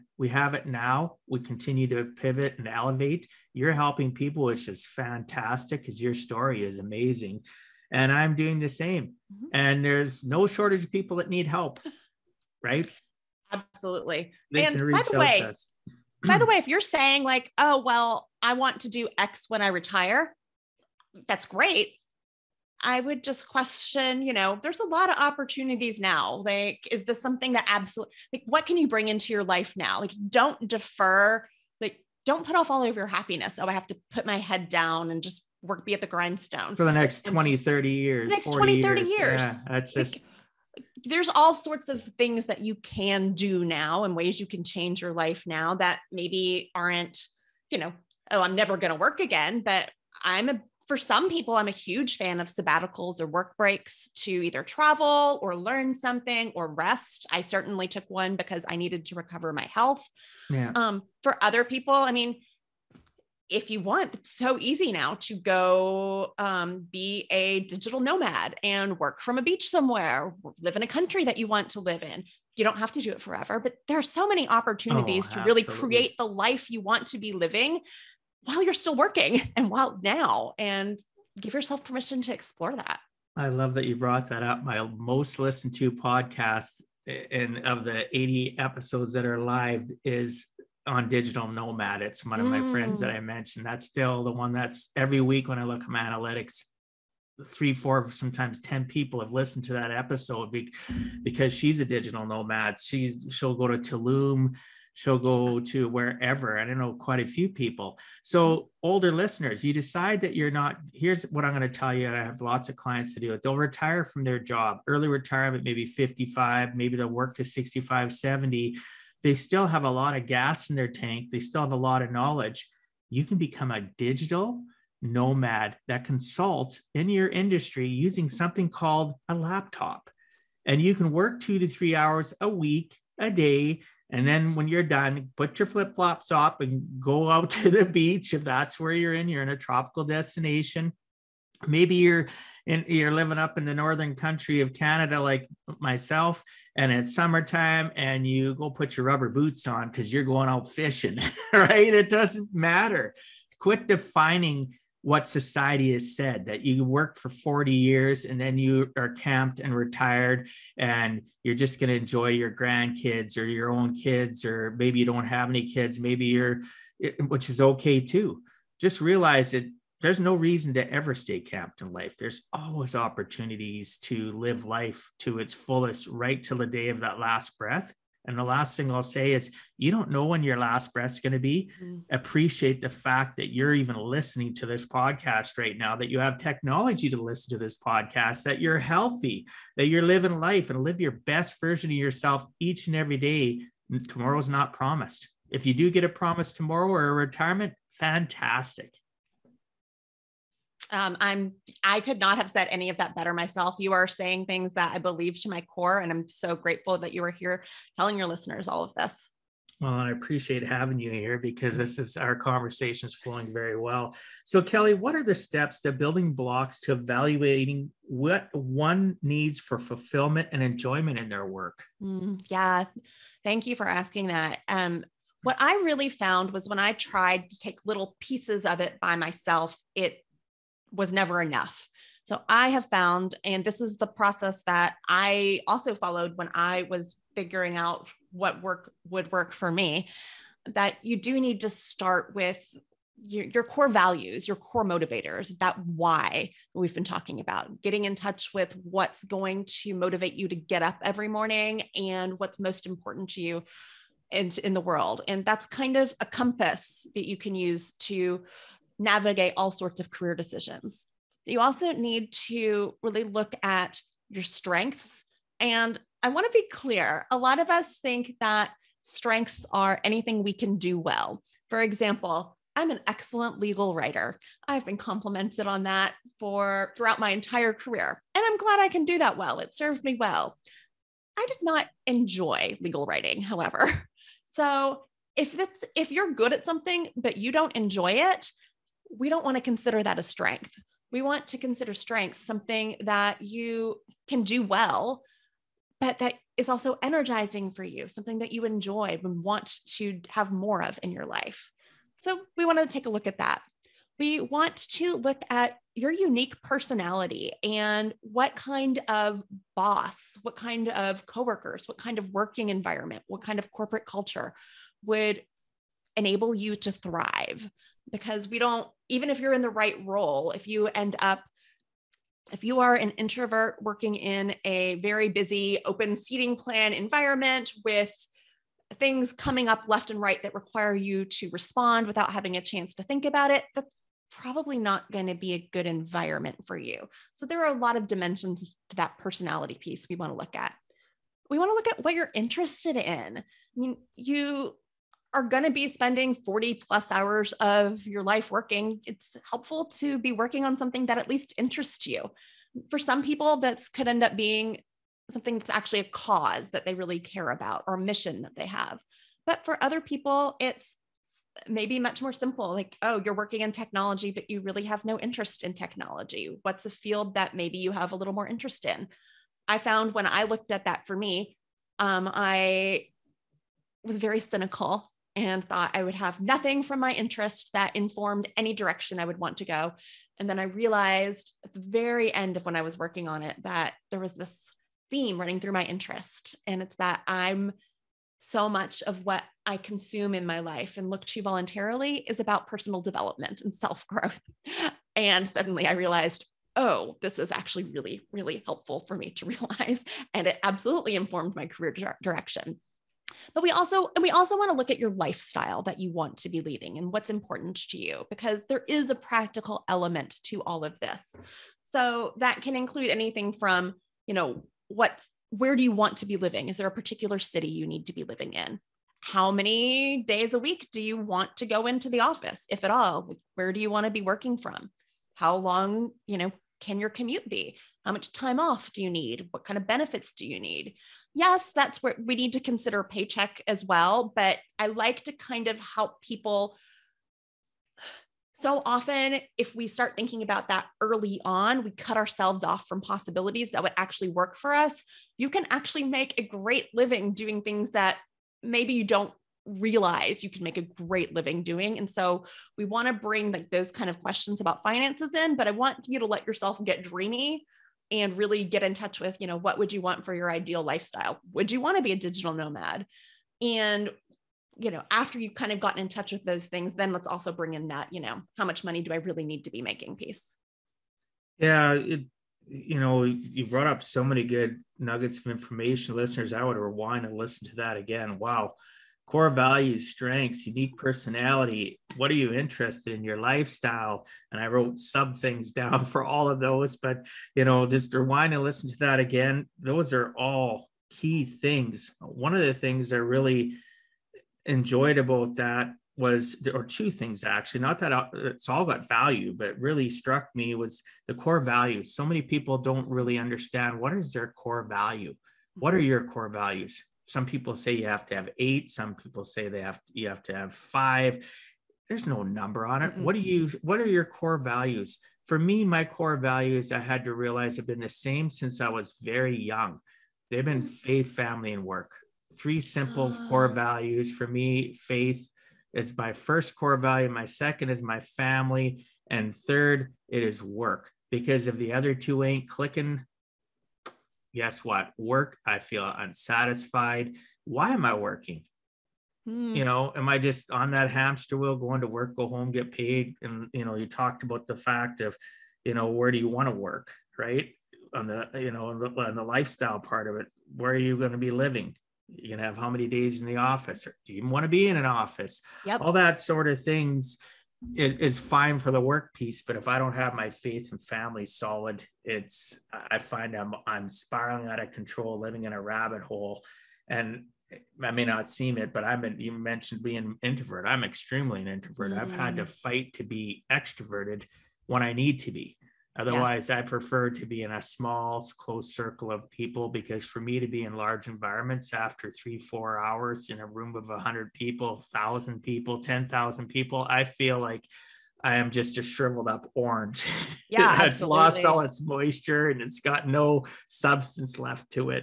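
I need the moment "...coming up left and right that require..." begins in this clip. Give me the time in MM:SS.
05:29.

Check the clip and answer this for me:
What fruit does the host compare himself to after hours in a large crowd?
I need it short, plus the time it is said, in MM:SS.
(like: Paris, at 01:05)
orange, at 09:49.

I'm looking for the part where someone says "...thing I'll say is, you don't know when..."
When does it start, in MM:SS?
02:58.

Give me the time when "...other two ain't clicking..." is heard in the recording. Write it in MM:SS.
08:51.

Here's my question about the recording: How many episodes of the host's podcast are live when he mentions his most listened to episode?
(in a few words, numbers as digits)
80.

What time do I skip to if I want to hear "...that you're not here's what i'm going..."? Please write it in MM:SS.
01:50.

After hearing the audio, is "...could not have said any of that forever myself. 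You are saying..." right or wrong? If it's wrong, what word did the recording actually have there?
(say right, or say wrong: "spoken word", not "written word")
wrong: "better", not "forever".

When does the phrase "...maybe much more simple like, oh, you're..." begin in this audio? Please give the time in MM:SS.
06:01.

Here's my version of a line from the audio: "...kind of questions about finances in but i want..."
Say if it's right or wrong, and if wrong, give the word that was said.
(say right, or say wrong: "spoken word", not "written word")
right.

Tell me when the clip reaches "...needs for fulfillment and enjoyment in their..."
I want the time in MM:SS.
03:39.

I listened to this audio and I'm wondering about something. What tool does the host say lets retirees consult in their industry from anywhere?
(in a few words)
a laptop.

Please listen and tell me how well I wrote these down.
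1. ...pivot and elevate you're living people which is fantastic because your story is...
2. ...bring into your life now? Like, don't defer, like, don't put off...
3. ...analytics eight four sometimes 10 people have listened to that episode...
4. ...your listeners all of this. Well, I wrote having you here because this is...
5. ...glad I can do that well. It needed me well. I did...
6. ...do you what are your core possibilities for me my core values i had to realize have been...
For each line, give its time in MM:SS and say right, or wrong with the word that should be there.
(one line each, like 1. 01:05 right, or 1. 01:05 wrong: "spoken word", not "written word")
1. 00:02 wrong: "helping", not "living"
2. 00:28 right
3. 01:35 wrong: "three", not "eight"
4. 03:28 wrong: "appreciate", not "wrote"
5. 04:38 wrong: "served", not "needed"
6. 08:33 wrong: "values", not "possibilities".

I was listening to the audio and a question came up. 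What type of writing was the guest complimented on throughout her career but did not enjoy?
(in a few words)
legal writing.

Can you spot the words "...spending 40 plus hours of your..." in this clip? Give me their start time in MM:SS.
05:45.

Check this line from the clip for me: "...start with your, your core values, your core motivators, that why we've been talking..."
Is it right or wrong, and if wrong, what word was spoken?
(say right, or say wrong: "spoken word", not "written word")
right.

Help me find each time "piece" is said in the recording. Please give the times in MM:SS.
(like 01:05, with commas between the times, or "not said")
03:48, 05:39, 07:50, 09:19.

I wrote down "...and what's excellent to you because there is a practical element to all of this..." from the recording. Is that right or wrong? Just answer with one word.
wrong.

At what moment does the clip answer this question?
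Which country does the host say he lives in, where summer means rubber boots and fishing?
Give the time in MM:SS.
02:24.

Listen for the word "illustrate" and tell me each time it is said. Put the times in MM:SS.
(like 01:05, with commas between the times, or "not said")
not said.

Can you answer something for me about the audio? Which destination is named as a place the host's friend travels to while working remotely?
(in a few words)
Tulum.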